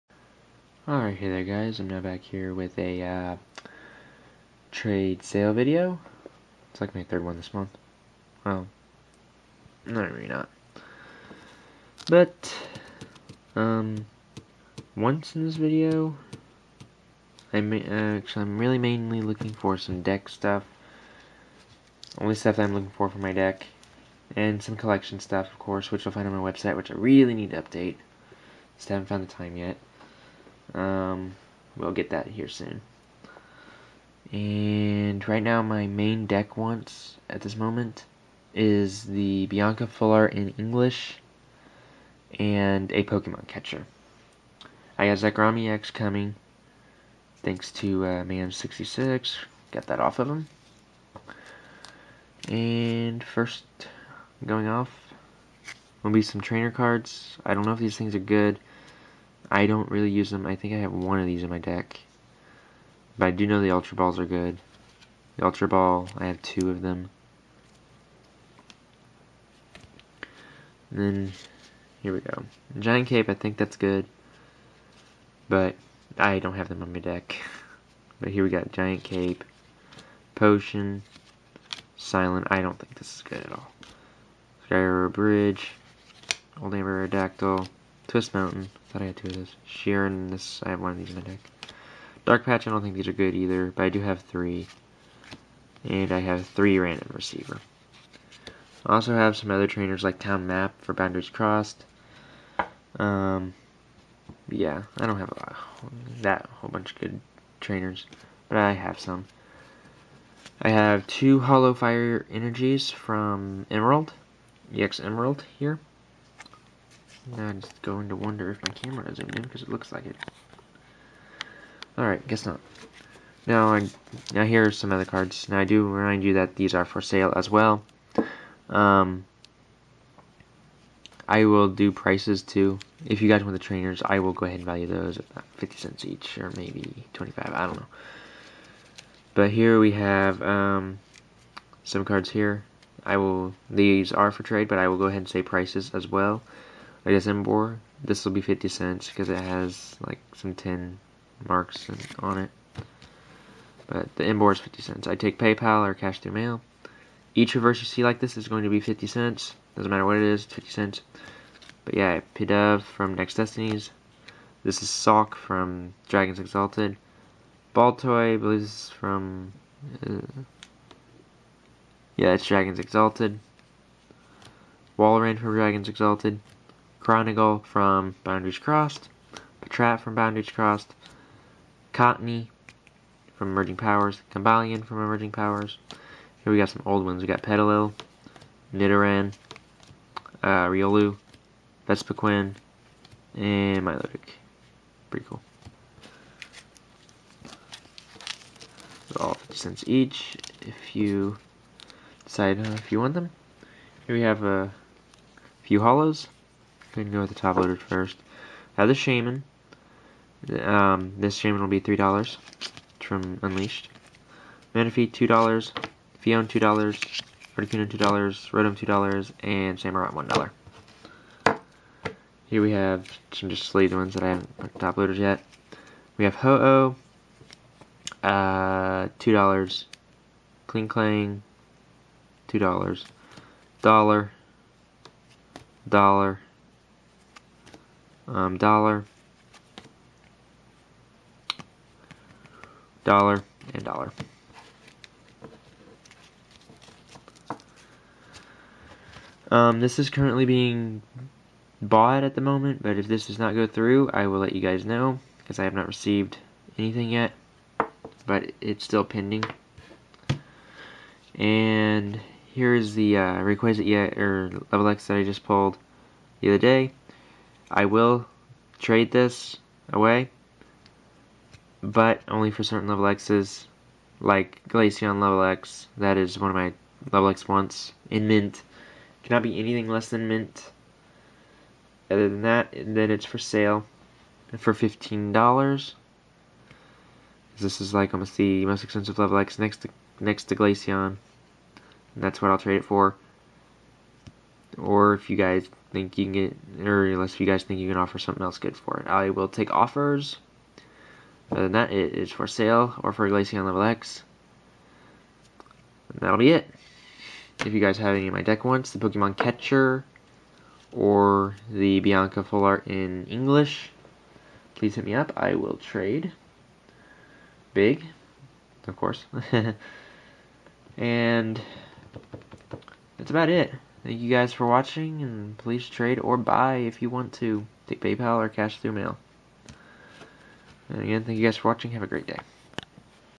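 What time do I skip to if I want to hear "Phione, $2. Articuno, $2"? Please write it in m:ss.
3:36.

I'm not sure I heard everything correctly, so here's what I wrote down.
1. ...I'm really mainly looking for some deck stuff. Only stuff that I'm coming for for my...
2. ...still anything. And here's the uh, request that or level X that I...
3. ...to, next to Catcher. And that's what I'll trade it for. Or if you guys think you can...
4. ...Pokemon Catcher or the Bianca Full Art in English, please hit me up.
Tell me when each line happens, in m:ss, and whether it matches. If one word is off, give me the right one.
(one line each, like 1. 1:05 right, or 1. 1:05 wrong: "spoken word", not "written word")
1. 0:18 wrong: "looking", not "coming"
2. 4:18 wrong: "pending", not "anything"
3. 4:49 wrong: "Glaceon", not "Catcher"
4. 5:08 right.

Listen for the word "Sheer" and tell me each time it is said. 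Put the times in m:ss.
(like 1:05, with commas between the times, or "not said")
1:29.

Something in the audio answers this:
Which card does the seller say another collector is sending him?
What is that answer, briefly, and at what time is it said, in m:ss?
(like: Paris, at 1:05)
Zekrom EX, at 0:45.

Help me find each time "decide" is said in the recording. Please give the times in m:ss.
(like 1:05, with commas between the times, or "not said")
3:22.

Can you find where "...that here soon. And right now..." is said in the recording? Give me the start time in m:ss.
0:32.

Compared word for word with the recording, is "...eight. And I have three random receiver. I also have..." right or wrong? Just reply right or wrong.
wrong.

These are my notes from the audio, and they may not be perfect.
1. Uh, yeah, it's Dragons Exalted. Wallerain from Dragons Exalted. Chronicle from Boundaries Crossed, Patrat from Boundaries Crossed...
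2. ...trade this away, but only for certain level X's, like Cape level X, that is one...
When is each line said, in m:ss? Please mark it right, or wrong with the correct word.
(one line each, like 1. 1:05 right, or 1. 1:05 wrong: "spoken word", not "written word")
1. 2:50 right
2. 4:28 wrong: "Glaceon", not "Cape".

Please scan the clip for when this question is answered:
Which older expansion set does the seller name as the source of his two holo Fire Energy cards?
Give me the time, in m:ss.
1:54.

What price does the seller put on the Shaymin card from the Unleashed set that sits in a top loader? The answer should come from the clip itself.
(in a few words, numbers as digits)
$3.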